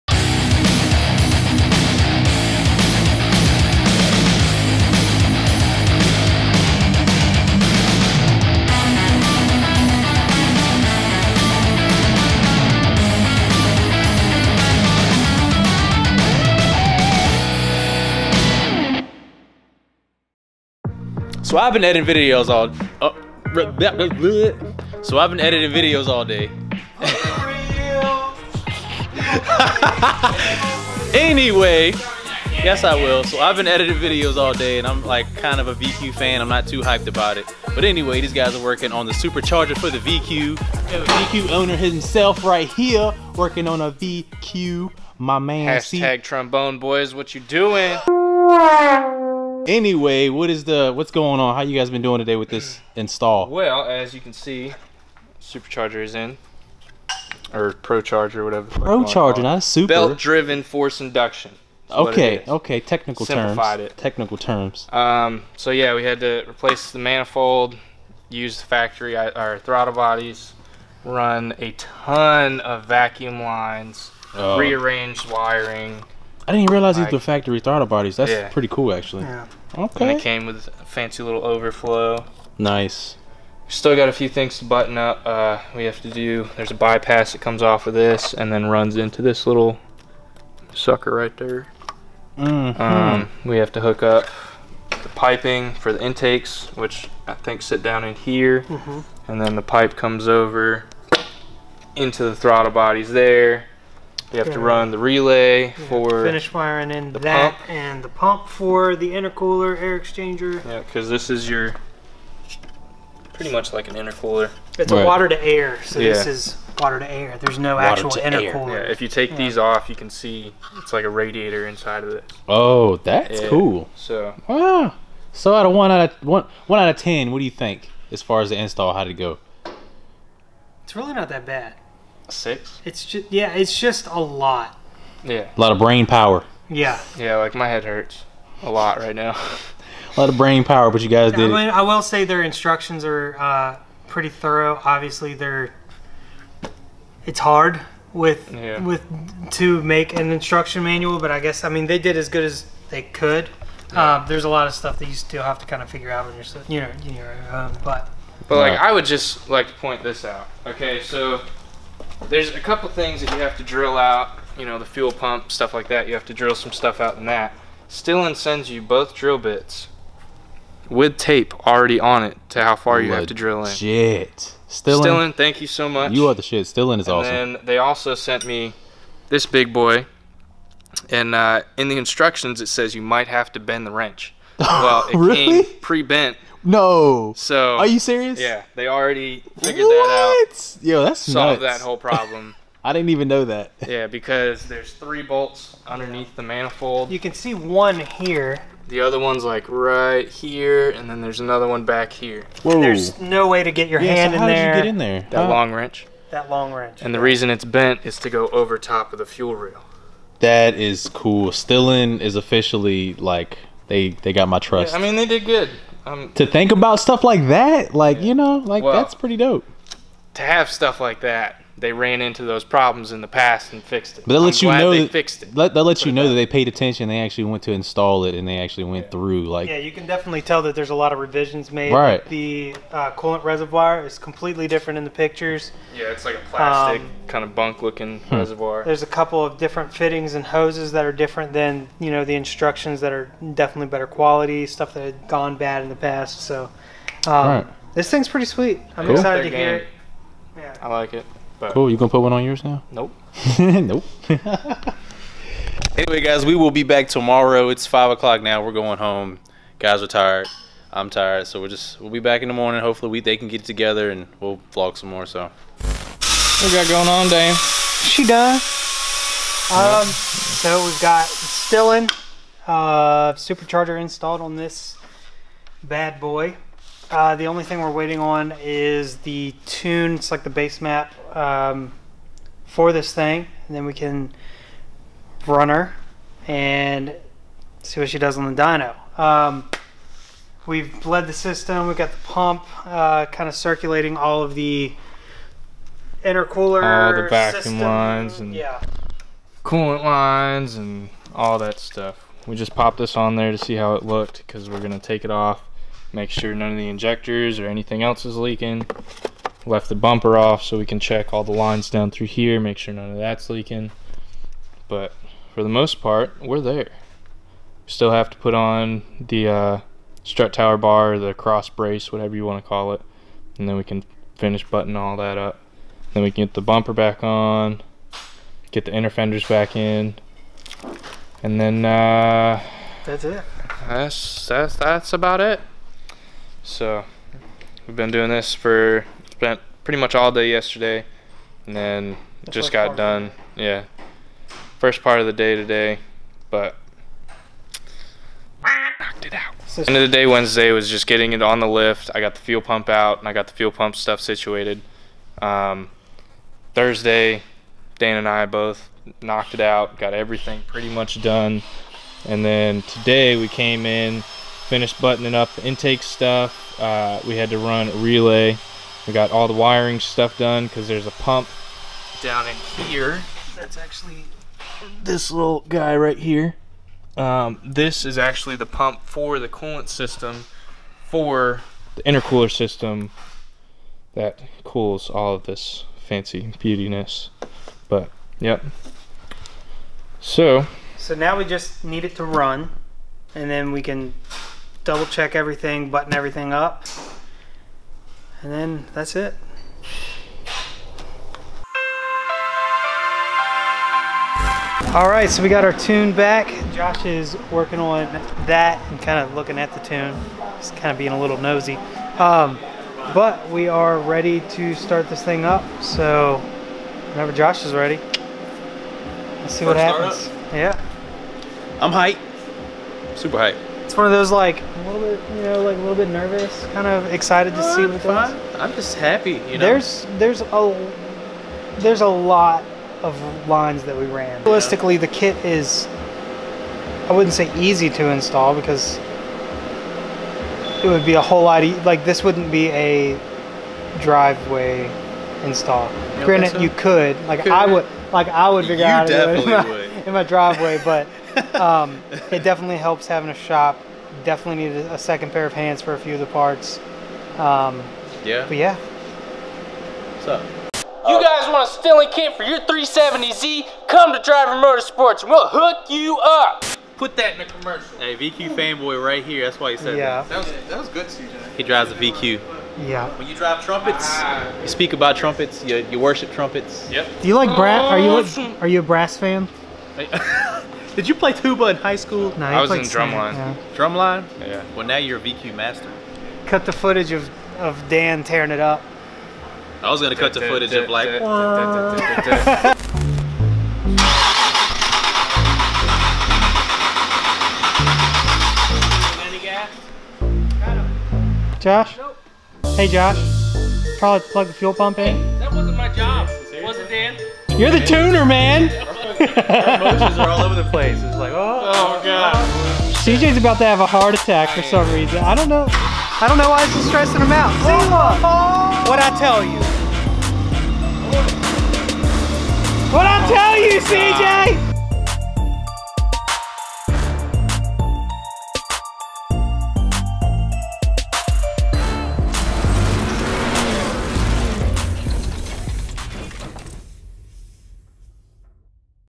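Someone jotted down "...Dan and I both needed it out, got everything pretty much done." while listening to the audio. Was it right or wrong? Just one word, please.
wrong.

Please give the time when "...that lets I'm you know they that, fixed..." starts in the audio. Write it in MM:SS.
03:44.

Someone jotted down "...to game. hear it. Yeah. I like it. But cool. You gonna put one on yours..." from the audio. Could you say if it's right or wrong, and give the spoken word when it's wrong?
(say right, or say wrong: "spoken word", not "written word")
right.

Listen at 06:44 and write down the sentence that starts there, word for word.
All right, so we got our tune back.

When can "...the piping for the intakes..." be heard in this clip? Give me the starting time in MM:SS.
01:34.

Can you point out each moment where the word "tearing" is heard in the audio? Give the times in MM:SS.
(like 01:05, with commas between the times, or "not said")
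08:08.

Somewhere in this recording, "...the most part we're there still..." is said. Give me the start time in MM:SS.
05:15.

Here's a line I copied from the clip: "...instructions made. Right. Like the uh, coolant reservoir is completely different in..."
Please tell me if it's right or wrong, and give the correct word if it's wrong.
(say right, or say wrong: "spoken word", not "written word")
wrong: "revisions", not "instructions".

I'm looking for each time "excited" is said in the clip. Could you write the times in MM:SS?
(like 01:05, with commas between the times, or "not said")
04:09, 07:07.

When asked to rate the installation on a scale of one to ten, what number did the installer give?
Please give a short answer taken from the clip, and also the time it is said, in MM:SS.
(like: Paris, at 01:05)
6, at 02:12.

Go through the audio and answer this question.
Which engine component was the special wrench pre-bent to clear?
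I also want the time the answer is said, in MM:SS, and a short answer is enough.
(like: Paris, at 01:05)
the fuel rail, at 03:29.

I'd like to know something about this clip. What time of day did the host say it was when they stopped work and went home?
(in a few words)
five o'clock.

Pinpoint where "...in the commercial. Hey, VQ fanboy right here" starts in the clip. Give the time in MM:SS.
07:47.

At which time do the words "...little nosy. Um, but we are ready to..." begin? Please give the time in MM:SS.
06:51.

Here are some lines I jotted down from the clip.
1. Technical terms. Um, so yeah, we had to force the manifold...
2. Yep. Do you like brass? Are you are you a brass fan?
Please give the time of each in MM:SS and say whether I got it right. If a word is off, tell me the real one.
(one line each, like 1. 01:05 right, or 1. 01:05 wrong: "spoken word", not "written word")
1. 01:03 wrong: "replace", not "force"
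2. 07:56 right.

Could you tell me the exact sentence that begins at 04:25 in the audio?
So, what we got going on, Dame?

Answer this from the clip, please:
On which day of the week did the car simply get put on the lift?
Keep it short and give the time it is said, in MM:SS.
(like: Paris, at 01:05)
Wednesday, at 05:50.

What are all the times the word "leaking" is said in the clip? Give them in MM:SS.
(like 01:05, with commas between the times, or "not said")
05:08, 05:13.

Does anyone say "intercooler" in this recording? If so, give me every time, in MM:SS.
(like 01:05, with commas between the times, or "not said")
01:49, 01:53, 01:58, 04:56, 06:22.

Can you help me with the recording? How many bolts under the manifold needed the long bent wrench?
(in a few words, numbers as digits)
3.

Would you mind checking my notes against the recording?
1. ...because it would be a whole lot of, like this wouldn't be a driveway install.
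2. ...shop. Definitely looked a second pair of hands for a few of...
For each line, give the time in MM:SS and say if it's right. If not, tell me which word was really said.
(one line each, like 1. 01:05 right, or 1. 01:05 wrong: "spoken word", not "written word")
1. 07:18 right
2. 07:33 wrong: "needed", not "looked".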